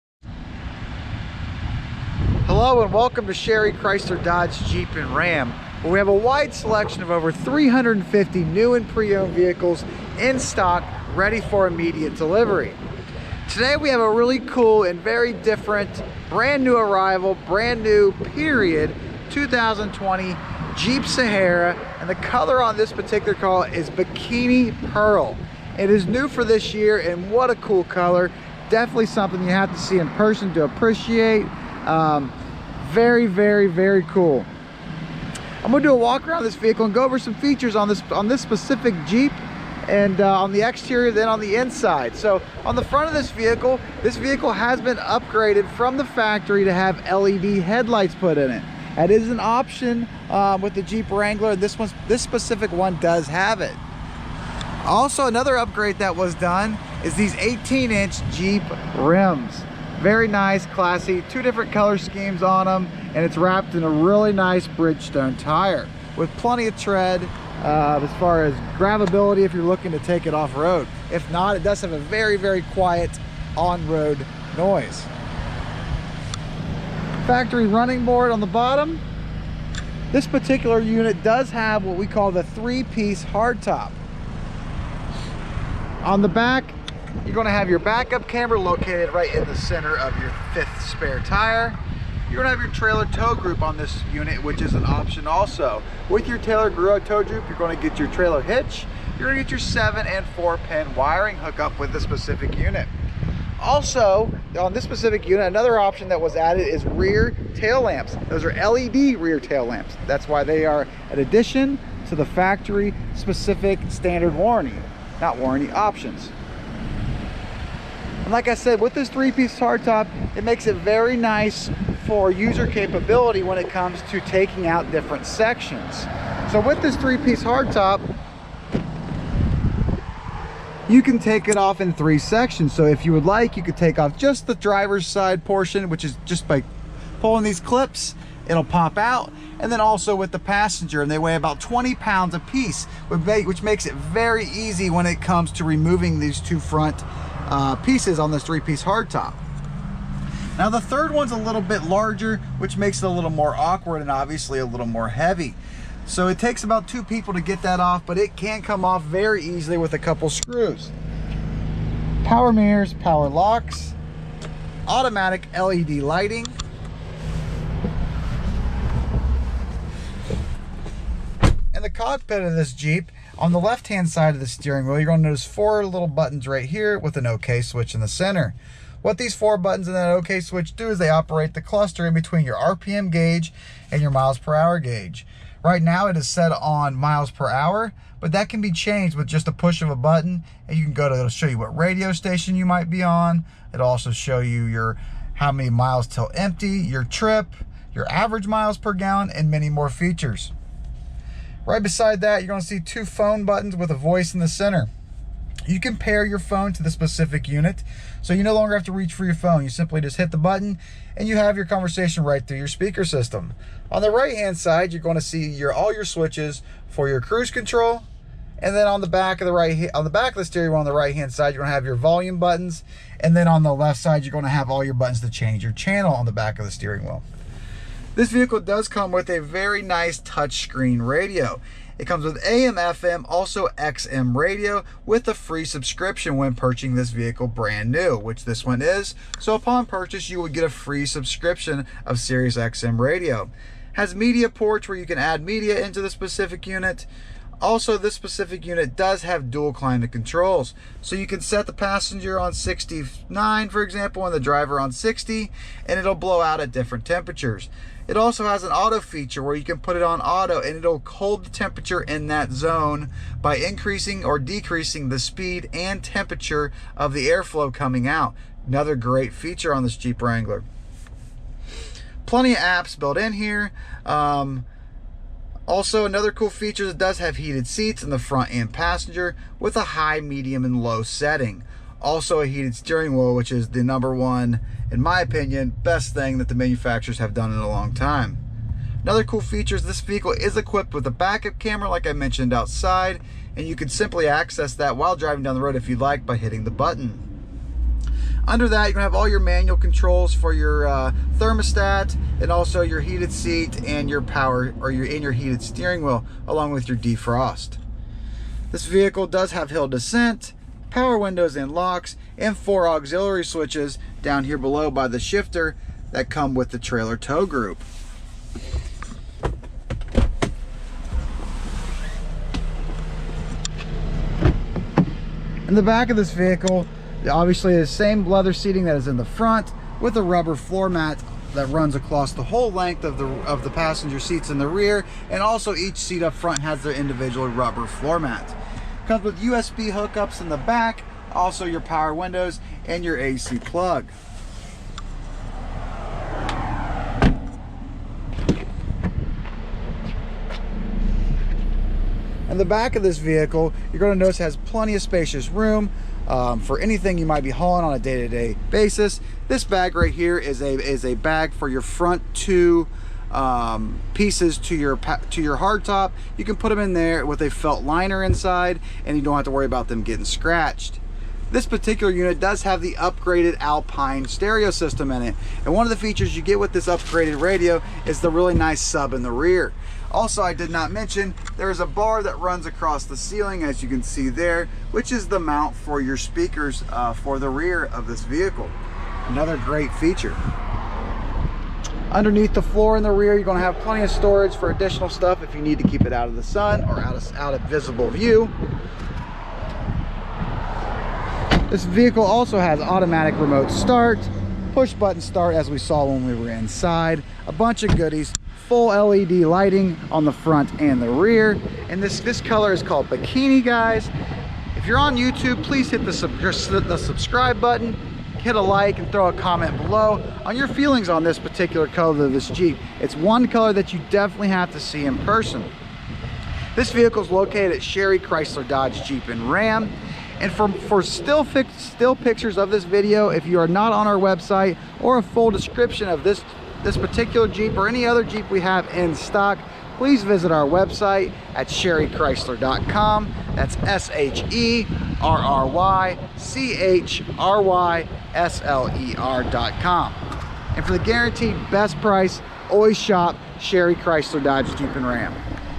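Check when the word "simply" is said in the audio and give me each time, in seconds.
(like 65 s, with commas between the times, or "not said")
209 s, 293 s.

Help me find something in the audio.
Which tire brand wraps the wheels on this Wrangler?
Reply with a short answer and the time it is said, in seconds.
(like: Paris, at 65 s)
Bridgestone, at 64 s.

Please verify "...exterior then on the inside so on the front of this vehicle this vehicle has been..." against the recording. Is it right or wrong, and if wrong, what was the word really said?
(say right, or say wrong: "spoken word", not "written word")
right.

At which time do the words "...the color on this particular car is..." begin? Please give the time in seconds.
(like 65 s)
22 s.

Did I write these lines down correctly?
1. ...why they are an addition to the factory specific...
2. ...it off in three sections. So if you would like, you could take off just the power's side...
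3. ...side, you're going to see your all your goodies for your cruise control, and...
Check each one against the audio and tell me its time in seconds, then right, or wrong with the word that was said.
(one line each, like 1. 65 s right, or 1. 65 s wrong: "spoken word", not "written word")
1. 110 s right
2. 131 s wrong: "driver", not "power"
3. 214 s wrong: "switches", not "goodies".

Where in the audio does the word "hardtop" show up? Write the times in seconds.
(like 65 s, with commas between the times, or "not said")
83 s, 119 s, 127 s, 148 s, 365 s.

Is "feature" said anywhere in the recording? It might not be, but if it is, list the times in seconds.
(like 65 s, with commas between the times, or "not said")
37 s, 199 s, 258 s, 269 s, 276 s, 289 s, 375 s, 389 s.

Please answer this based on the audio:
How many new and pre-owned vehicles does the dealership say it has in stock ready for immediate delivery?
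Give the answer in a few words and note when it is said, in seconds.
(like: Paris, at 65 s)
over 350, at 7 s.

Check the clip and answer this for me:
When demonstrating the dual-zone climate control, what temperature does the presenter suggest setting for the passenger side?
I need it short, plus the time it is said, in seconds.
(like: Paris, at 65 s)
69, at 252 s.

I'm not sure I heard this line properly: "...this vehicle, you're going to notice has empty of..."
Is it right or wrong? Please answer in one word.
wrong.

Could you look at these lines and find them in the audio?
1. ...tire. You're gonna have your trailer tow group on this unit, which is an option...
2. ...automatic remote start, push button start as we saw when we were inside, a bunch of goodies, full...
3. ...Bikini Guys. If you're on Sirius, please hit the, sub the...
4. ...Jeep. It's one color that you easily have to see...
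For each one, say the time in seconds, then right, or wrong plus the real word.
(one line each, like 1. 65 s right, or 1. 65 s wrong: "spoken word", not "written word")
1. 91 s right
2. 402 s right
3. 413 s wrong: "YouTube", not "Sirius"
4. 422 s wrong: "definitely", not "easily".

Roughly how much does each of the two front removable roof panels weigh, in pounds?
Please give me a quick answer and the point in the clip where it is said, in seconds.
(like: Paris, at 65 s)
20, at 141 s.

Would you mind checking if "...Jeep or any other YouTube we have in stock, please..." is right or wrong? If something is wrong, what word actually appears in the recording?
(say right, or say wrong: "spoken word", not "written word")
wrong: "Jeep", not "YouTube".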